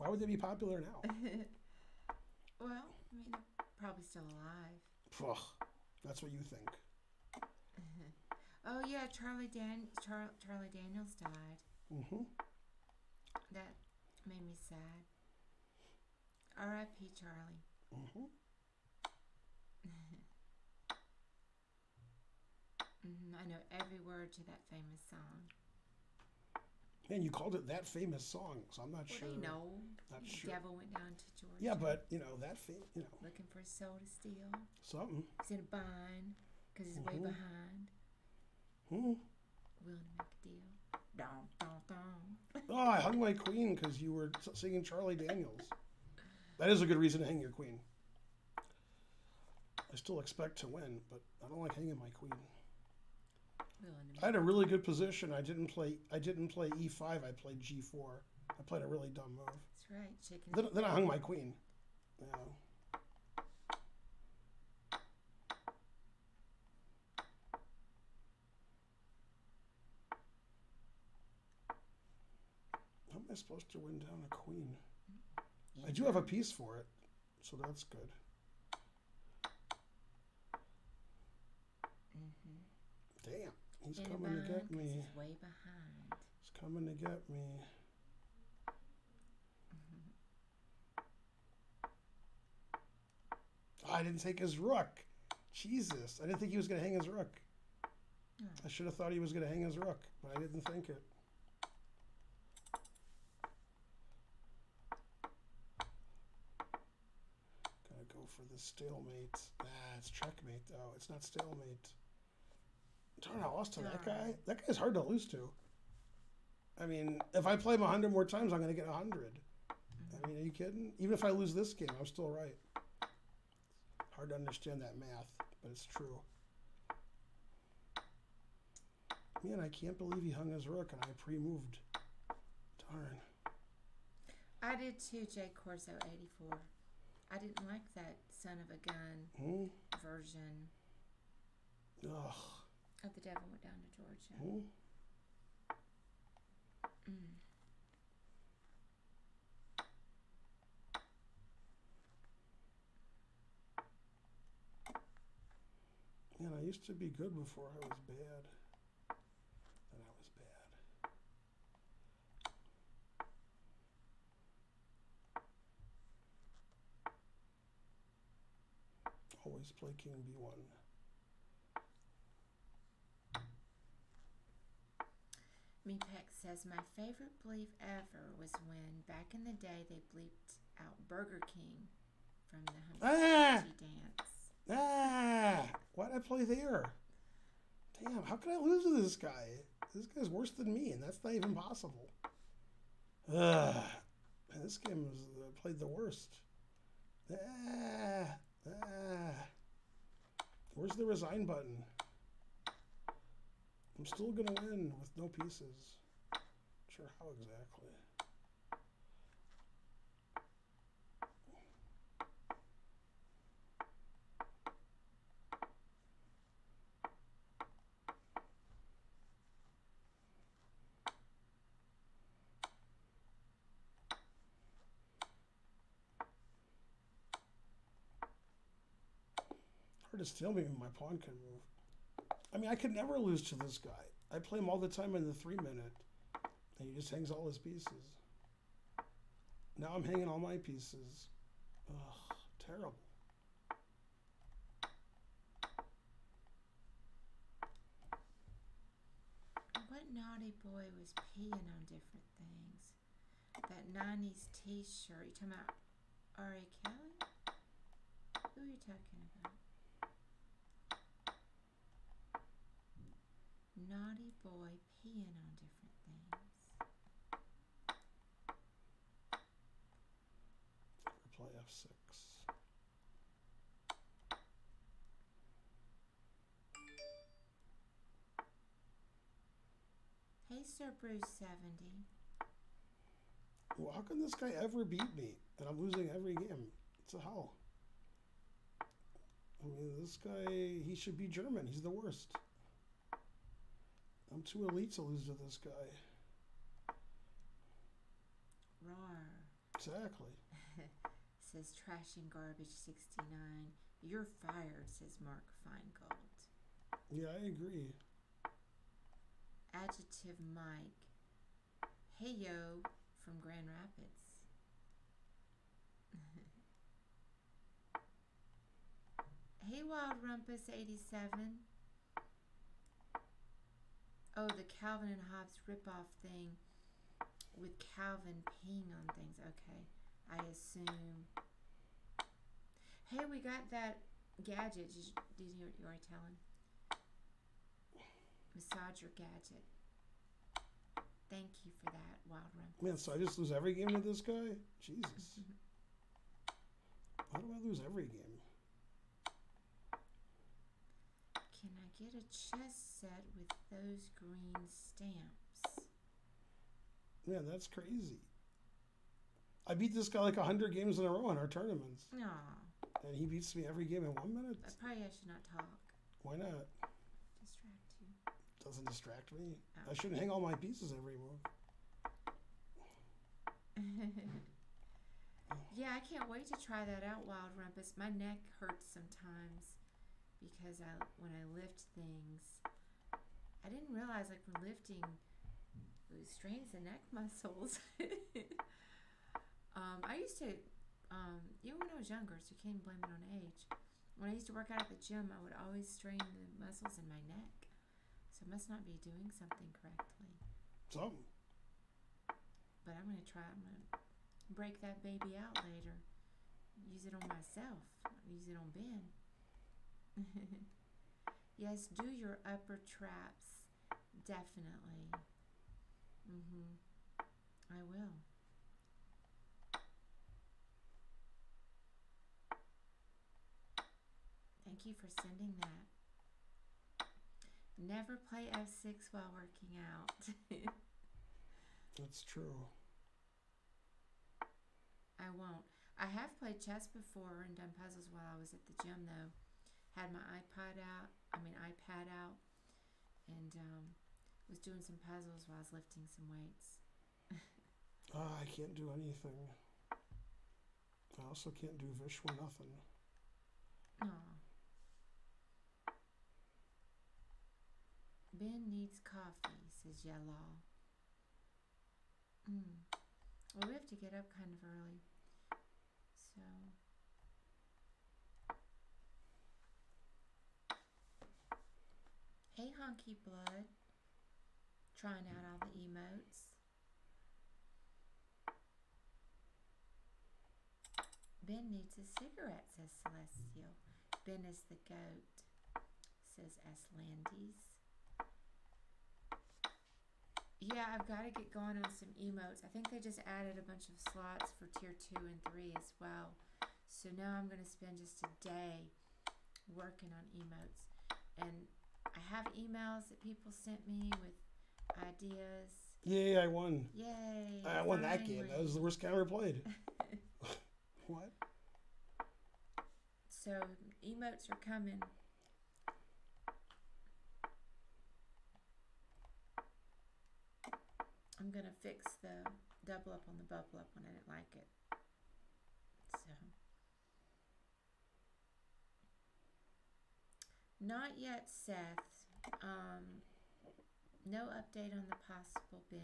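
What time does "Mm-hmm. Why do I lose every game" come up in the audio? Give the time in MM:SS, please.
05:45.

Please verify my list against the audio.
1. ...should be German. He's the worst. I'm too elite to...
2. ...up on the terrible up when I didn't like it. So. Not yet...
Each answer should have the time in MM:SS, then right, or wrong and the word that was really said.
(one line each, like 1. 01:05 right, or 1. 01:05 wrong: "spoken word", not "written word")
1. 04:50 right
2. 08:43 wrong: "bubble", not "terrible".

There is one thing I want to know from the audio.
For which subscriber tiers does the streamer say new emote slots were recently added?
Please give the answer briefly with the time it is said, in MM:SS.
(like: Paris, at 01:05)
tier 2 and 3, at 08:14.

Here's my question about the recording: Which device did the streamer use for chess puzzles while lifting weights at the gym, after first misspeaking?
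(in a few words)
iPad.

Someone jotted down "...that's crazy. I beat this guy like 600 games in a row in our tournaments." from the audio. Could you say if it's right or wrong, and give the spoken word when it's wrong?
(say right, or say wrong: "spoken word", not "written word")
wrong: "100", not "600".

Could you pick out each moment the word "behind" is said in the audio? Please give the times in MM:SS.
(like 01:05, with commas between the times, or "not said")
00:37, 01:25.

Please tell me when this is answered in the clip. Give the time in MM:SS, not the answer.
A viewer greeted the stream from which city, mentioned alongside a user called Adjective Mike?
05:13.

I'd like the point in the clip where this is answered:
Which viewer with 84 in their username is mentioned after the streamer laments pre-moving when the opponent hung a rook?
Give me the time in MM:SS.
02:15.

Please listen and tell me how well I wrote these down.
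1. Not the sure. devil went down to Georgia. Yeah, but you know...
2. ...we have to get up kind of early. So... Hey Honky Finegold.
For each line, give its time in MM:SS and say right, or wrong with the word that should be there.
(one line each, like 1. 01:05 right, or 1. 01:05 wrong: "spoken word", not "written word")
1. 00:30 right
2. 07:43 wrong: "Blood", not "Finegold".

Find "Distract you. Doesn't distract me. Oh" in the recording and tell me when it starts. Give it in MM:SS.
06:07.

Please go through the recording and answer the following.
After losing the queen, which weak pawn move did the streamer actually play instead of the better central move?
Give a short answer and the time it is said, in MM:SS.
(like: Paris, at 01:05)
g4, at 00:57.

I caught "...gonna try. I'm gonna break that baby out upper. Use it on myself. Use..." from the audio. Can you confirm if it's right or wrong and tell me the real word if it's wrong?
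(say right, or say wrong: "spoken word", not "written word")
wrong: "later", not "upper".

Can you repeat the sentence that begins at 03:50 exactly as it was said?
just filming and my pawn can move.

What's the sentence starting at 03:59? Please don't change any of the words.
Now I'm hanging all my pieces.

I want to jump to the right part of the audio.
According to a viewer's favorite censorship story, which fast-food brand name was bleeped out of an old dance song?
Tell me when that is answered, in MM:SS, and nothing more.
03:01.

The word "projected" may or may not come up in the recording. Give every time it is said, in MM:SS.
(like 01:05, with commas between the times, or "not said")
not said.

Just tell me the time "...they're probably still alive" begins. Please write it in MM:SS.
00:03.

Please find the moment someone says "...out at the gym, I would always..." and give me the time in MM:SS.
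06:34.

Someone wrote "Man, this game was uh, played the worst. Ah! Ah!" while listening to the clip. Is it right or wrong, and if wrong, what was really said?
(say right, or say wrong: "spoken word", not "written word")
right.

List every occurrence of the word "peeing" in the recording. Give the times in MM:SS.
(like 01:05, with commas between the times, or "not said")
04:11, 04:25, 05:28.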